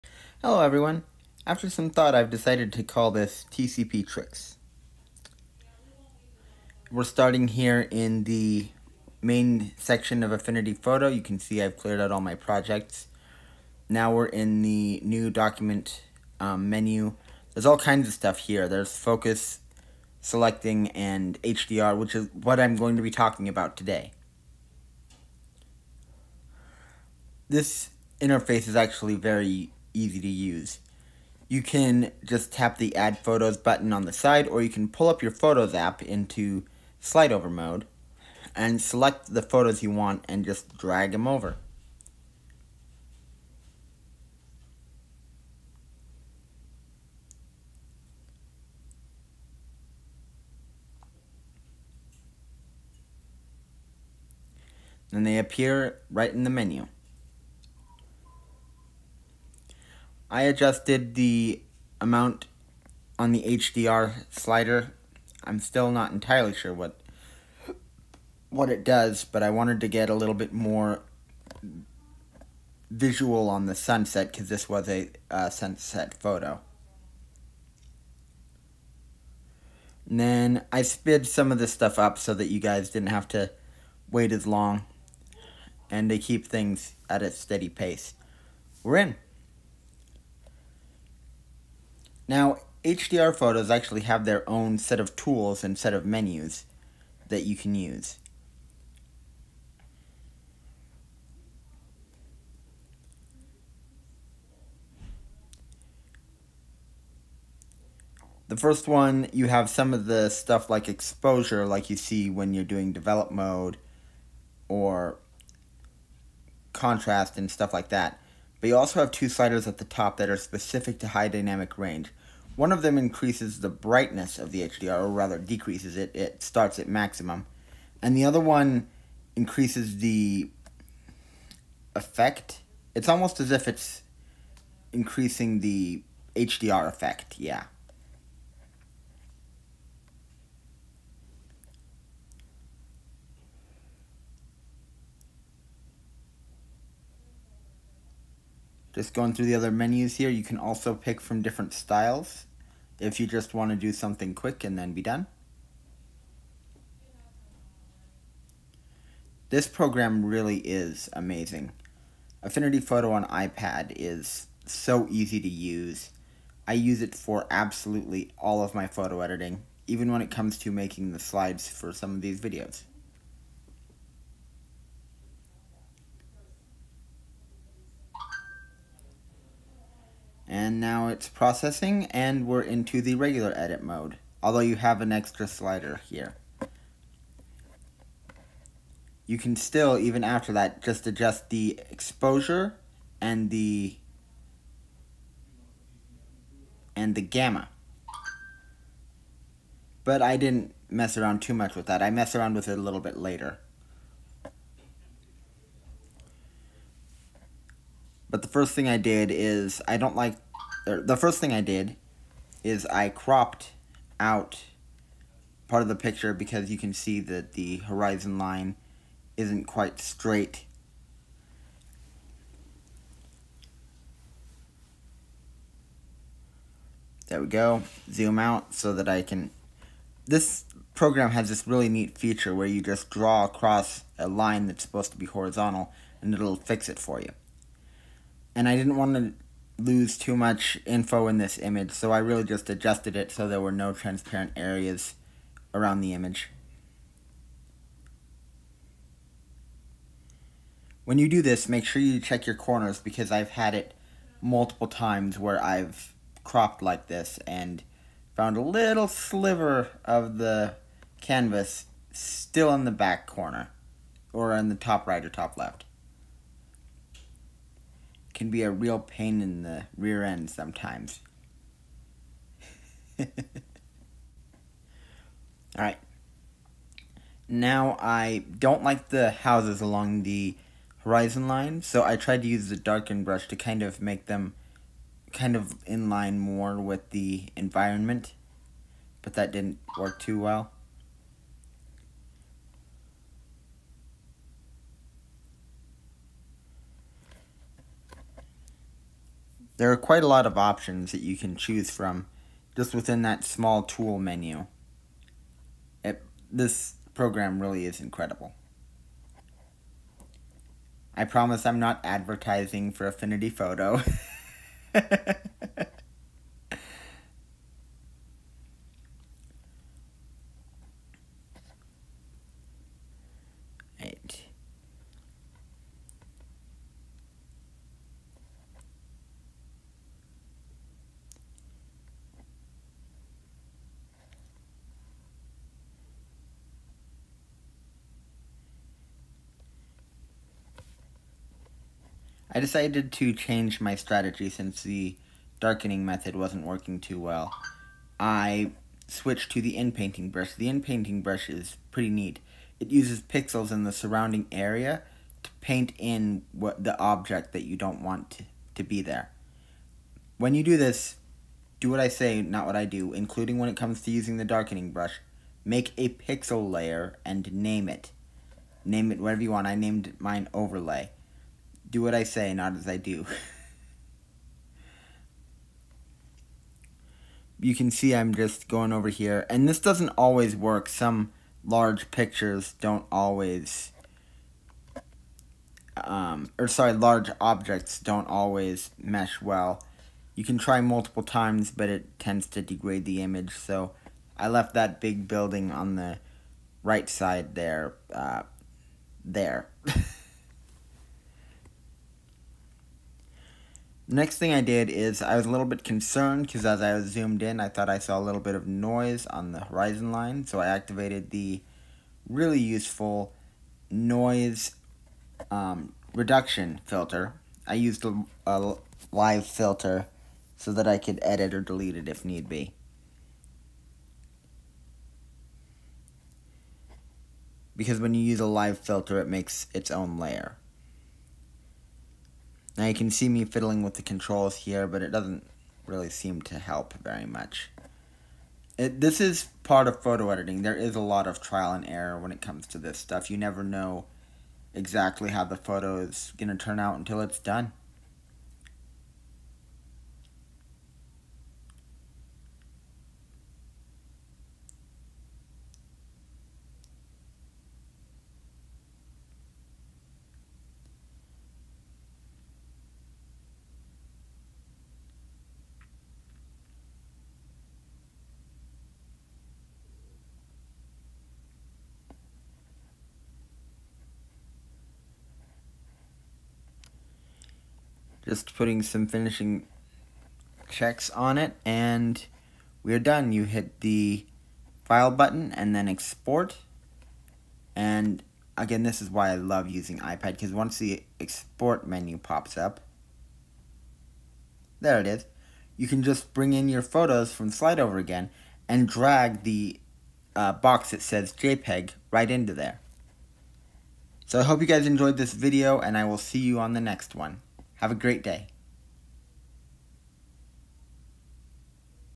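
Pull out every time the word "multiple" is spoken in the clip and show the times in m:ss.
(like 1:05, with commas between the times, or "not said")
4:14, 6:30.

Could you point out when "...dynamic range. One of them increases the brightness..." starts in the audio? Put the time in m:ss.
2:01.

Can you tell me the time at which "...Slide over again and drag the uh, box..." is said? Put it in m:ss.
8:17.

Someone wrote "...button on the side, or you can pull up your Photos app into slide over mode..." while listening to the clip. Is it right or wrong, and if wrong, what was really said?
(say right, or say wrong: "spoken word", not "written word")
right.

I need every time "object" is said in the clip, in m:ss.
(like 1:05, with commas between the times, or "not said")
5:56, 6:27.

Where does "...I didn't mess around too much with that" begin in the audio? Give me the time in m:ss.
3:20.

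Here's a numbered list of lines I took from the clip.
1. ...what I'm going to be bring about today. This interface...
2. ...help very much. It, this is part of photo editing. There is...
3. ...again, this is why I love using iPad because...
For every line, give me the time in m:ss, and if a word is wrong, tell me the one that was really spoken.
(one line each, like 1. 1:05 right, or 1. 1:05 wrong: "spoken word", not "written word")
1. 0:22 wrong: "talking", not "bring"
2. 7:16 right
3. 8:08 right.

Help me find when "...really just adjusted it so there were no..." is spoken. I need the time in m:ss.
4:02.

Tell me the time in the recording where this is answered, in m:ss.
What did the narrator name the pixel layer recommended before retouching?
6:10.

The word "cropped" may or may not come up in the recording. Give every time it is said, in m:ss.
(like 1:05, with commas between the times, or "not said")
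3:33, 4:16.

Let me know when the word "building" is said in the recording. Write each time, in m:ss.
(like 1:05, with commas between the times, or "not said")
6:35.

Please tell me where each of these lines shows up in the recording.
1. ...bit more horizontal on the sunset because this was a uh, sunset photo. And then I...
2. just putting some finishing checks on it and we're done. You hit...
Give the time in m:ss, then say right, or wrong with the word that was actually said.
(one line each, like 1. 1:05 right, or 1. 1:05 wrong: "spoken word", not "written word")
1. 1:10 wrong: "visual", not "horizontal"
2. 7:58 right.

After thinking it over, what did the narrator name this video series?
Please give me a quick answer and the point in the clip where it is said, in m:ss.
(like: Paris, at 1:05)
TCP tricks, at 0:03.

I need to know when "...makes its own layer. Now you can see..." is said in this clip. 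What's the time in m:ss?
7:09.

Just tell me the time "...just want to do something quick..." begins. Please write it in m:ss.
2:33.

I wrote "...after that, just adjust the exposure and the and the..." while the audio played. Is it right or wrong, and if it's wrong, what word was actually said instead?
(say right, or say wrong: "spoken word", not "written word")
right.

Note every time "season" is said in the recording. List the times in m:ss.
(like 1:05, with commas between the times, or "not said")
not said.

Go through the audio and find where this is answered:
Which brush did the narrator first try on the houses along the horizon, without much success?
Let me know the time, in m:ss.
4:42.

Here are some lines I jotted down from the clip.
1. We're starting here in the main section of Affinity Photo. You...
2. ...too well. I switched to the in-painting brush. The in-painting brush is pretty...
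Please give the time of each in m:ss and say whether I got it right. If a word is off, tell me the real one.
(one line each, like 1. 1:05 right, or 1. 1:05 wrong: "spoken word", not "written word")
1. 0:06 right
2. 5:46 right.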